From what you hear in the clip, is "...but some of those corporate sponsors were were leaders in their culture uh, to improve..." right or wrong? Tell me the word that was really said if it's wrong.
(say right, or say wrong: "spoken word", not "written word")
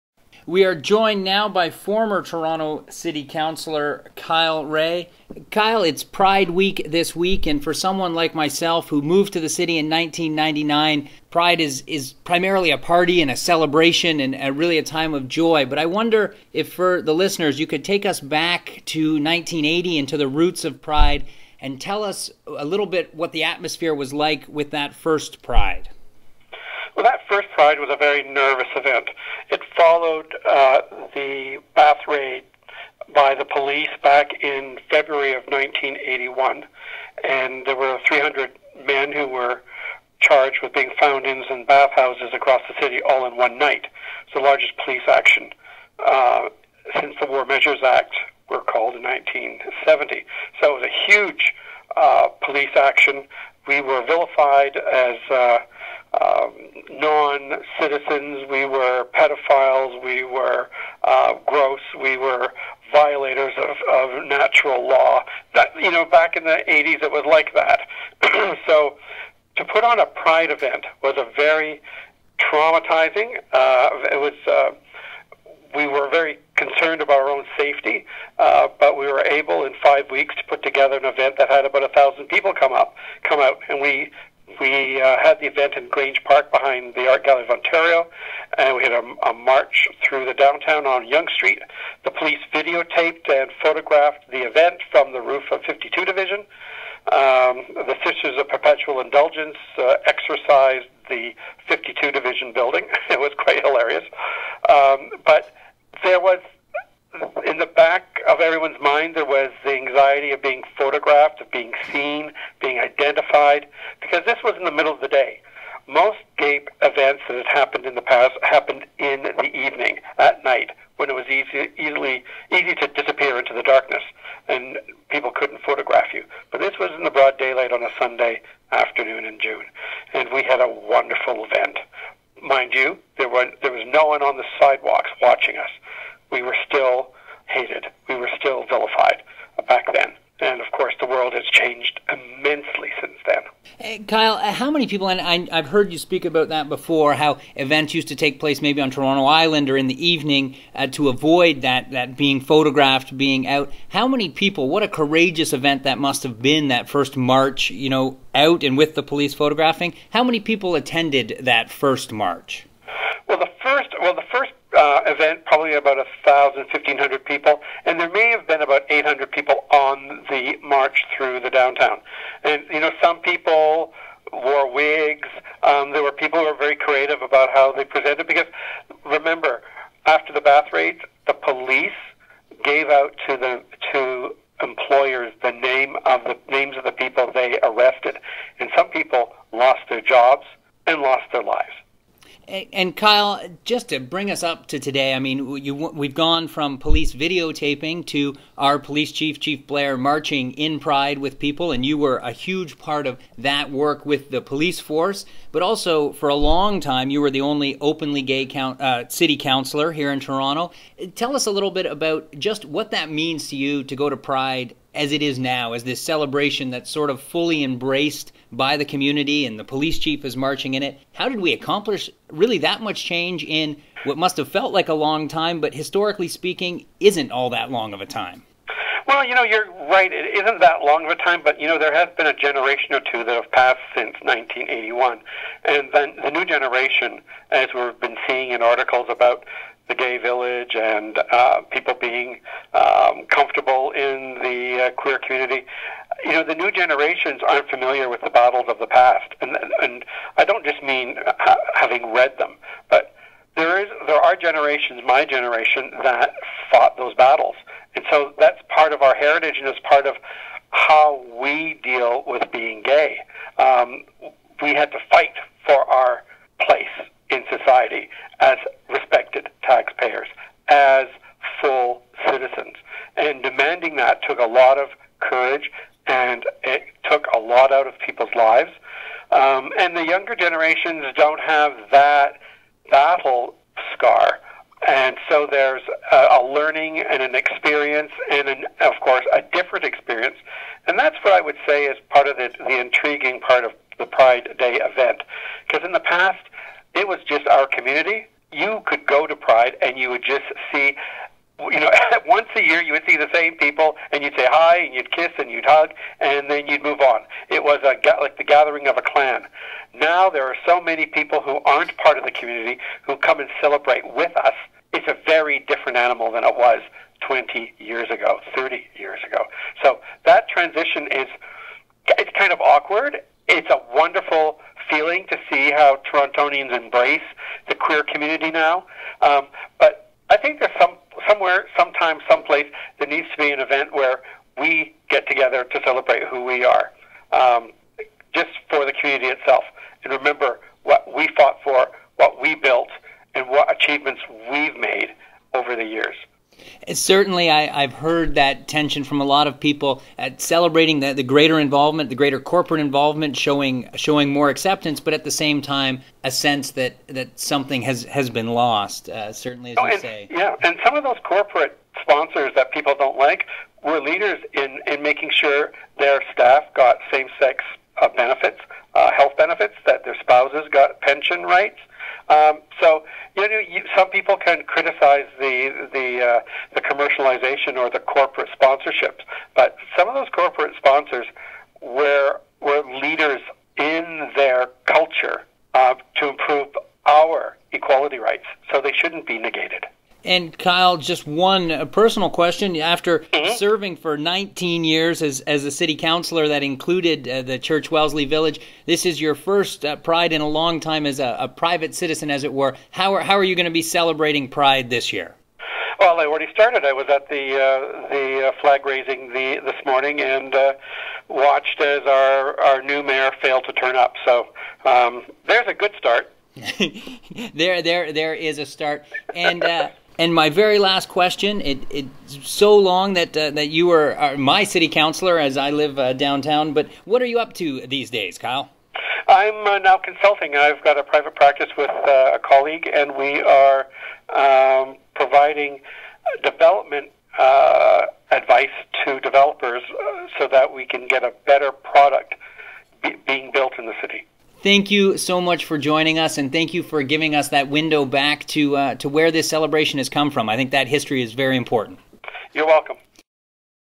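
right.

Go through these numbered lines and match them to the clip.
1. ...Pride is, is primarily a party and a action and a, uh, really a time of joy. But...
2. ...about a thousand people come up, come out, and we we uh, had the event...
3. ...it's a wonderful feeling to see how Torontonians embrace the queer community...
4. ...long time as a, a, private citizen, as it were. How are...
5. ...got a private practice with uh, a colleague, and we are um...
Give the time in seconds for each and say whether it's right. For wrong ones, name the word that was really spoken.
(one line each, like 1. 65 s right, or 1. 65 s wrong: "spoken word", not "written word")
1. 11 s wrong: "celebration", not "action"
2. 81 s right
3. 323 s right
4. 400 s right
5. 430 s right.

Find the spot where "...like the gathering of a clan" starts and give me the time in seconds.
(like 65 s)
308 s.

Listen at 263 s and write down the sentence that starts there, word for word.
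Um, we had to fight for our place in society as respected taxpayers, as full citizens.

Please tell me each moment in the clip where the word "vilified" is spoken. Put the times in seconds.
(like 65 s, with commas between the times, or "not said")
54 s, 138 s.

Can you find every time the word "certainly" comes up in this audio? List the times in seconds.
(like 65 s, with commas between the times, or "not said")
346 s, 359 s.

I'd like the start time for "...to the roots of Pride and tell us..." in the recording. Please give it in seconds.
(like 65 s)
20 s.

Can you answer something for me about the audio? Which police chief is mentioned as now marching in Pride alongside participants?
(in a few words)
Chief Blair.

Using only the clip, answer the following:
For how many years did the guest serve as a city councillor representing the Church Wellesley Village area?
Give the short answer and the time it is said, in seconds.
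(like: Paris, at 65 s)
19, at 394 s.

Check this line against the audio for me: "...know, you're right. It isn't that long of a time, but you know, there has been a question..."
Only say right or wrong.
wrong.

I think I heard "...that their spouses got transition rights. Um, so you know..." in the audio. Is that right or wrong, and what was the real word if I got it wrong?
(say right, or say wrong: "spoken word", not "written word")
wrong: "pension", not "transition".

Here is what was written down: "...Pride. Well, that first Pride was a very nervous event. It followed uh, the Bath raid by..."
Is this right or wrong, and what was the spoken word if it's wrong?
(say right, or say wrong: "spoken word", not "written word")
right.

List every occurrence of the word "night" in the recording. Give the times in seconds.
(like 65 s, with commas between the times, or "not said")
43 s, 120 s.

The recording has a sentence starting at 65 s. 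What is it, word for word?
That, you know, back in the 80s, it was like that.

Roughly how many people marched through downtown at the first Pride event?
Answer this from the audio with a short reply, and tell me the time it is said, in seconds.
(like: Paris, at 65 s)
800, at 168 s.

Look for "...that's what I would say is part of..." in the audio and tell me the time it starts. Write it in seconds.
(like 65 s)
290 s.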